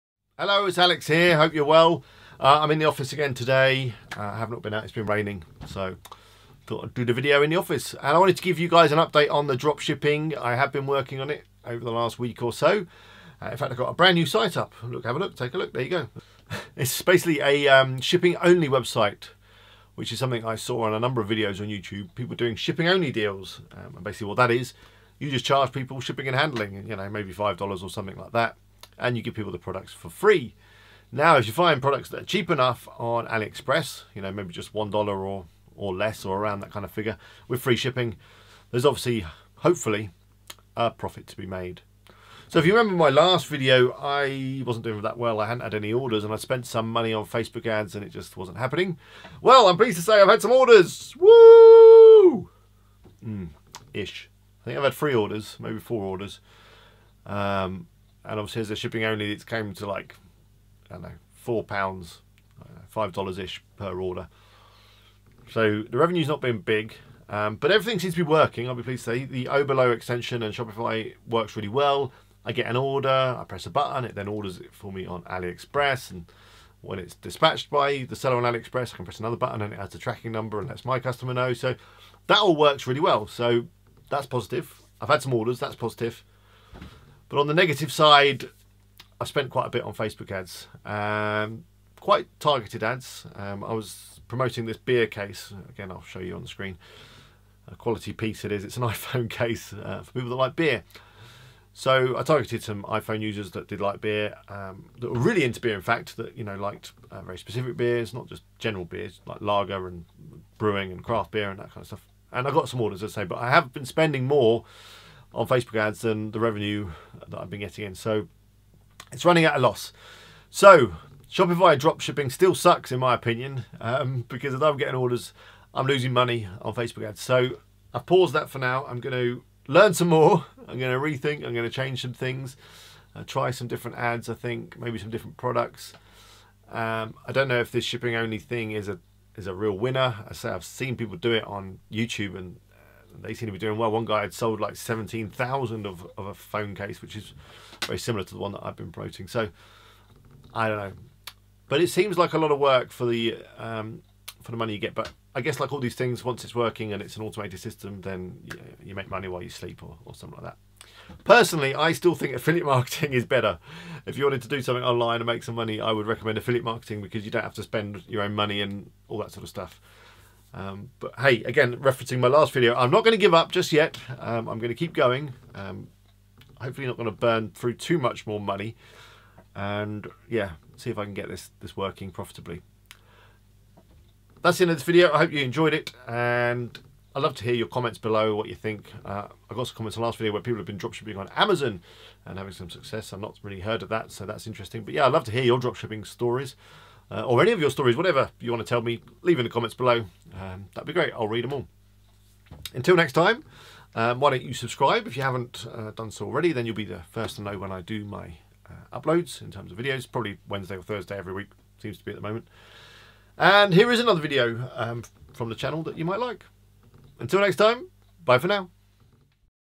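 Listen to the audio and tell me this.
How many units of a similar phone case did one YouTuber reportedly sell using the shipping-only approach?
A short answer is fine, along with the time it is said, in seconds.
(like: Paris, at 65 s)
17,000, at 144 s.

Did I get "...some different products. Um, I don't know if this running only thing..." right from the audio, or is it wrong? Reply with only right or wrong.
wrong.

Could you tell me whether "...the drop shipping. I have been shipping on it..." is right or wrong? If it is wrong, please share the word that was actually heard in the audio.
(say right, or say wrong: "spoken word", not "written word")
wrong: "working", not "shipping".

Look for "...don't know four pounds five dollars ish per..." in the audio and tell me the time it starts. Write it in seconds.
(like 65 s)
60 s.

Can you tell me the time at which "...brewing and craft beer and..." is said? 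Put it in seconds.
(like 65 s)
110 s.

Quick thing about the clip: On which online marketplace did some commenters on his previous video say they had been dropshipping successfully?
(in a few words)
Amazon.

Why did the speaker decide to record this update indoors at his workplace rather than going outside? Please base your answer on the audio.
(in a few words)
It's been raining.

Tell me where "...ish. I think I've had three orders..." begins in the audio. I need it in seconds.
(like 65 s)
53 s.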